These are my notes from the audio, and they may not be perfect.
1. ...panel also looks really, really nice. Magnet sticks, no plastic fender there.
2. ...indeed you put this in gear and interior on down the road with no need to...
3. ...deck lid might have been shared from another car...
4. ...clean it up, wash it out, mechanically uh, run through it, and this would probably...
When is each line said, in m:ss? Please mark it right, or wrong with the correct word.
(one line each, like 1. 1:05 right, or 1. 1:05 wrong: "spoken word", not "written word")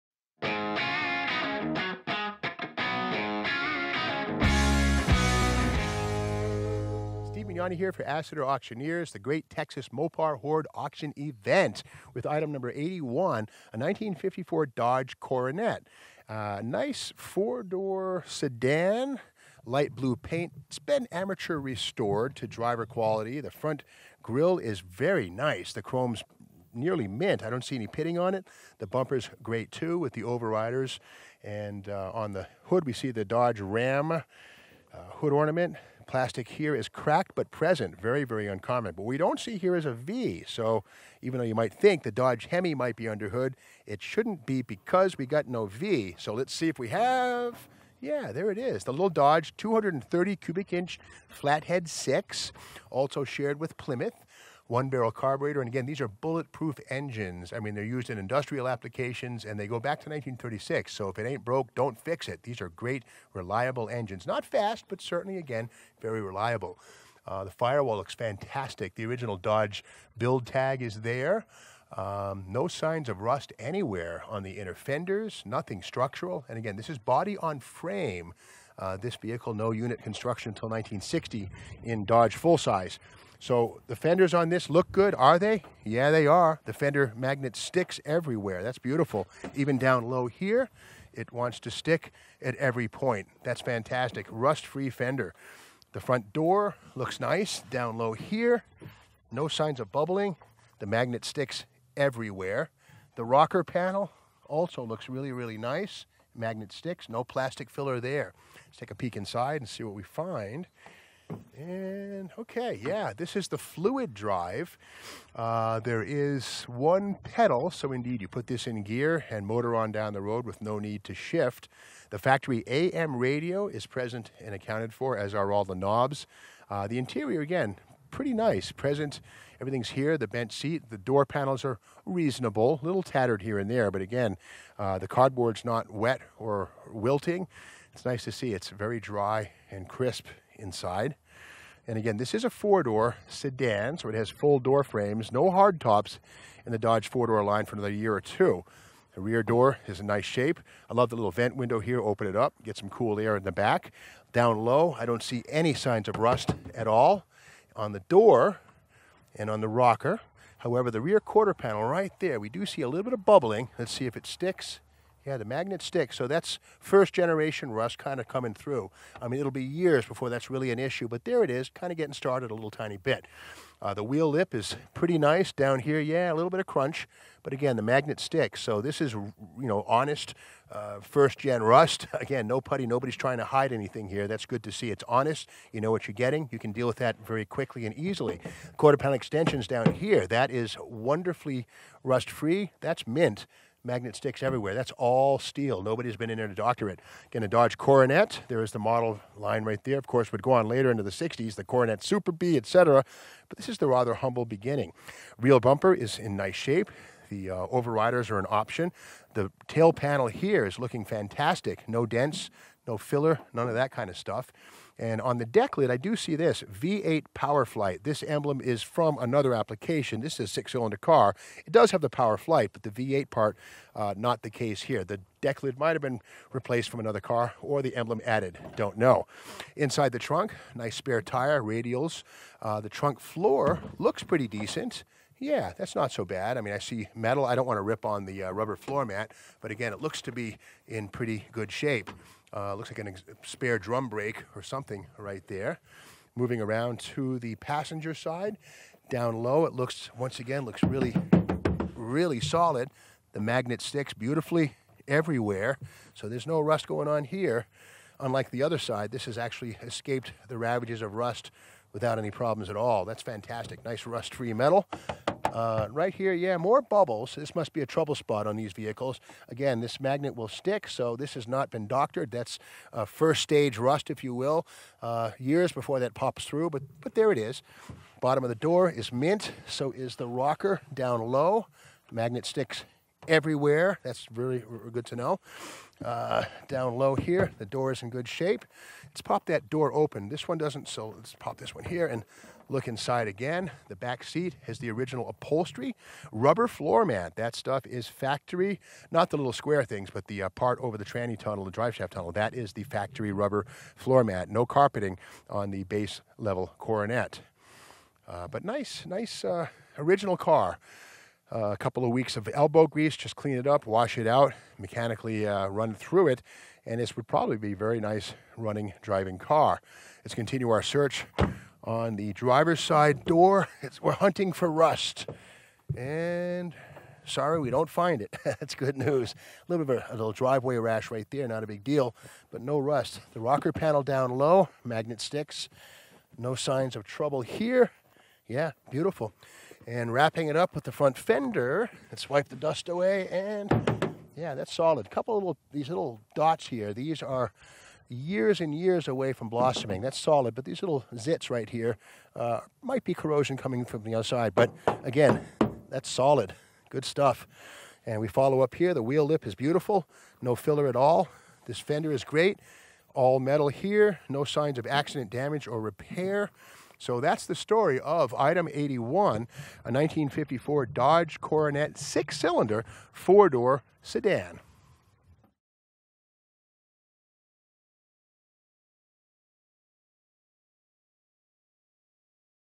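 1. 1:43 wrong: "filler", not "fender"
2. 1:57 wrong: "motor", not "interior"
3. 3:45 wrong: "replaced", not "shared"
4. 5:13 right.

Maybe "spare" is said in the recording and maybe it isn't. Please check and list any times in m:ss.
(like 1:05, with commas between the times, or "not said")
3:50, 4:03.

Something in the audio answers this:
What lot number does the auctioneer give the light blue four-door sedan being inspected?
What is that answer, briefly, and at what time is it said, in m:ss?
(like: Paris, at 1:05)
81, at 0:12.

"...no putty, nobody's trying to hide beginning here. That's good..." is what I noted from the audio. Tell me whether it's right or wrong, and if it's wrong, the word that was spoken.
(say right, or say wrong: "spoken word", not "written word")
wrong: "anything", not "beginning".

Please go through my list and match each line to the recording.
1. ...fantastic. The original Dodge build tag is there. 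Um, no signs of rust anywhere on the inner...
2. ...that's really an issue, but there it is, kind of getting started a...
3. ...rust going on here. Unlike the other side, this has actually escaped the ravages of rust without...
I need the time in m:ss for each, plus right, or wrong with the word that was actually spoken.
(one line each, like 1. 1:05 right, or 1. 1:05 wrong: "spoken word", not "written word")
1. 1:08 right
2. 2:50 right
3. 4:16 right.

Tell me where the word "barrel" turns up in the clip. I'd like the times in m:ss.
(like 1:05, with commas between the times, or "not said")
0:54.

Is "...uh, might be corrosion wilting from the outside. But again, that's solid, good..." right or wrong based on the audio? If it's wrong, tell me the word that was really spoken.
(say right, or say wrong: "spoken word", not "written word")
wrong: "coming", not "wilting".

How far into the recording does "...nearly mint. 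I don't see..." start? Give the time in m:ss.
0:26.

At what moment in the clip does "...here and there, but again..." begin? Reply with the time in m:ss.
2:13.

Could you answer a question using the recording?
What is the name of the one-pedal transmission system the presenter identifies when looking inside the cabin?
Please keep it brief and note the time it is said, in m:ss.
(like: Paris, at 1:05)
fluid drive, at 1:53.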